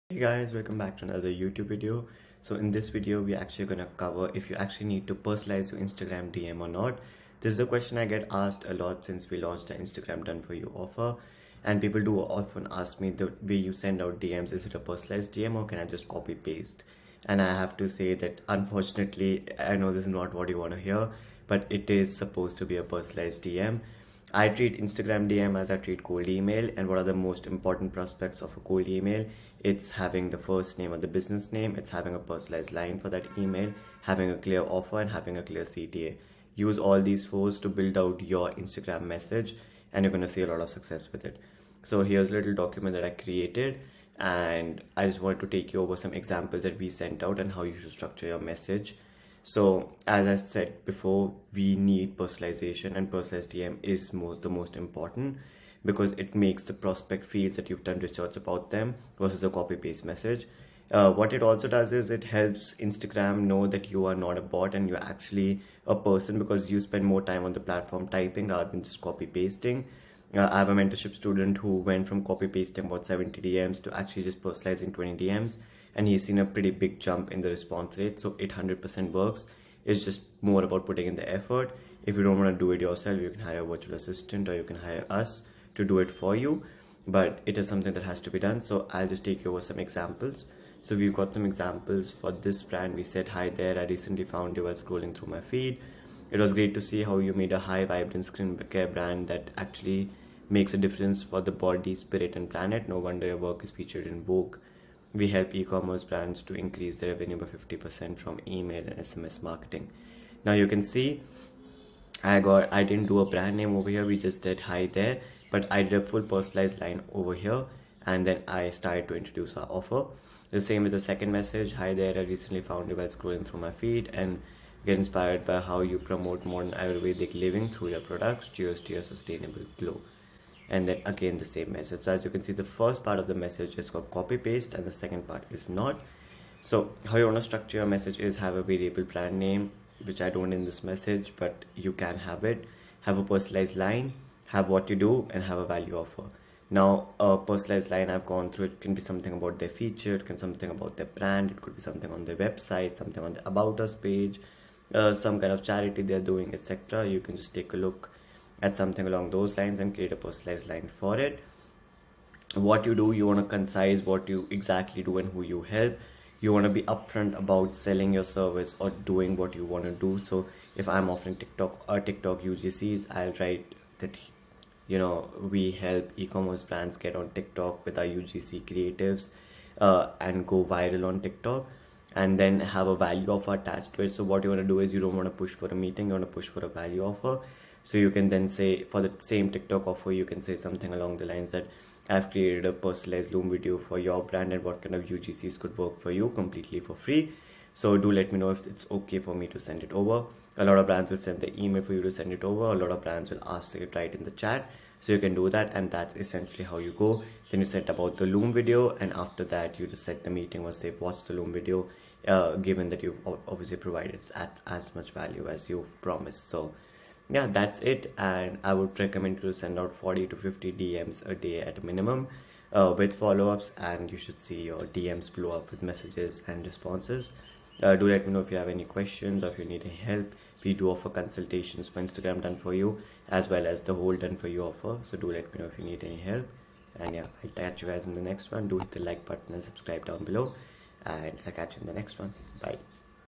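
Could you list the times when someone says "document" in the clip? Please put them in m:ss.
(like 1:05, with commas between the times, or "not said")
0:42.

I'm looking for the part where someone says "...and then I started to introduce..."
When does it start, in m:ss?
1:58.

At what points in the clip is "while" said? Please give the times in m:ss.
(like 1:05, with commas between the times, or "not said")
1:34, 2:02.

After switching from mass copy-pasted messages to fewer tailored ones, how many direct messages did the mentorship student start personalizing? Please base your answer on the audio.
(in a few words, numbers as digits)
20.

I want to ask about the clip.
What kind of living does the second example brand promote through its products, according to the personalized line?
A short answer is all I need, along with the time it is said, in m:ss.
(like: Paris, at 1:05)
Modern Ayurvedic living, at 2:06.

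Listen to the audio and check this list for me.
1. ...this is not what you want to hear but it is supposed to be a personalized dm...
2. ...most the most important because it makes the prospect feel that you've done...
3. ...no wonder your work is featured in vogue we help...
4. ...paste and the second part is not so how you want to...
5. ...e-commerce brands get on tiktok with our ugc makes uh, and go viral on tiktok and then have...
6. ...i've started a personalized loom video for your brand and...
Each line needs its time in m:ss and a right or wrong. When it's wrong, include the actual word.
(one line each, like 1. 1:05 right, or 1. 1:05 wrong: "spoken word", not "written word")
1. 0:19 right
2. 0:54 right
3. 1:42 right
4. 2:14 right
5. 2:56 wrong: "creatives", not "makes"
6. 3:12 wrong: "created", not "started".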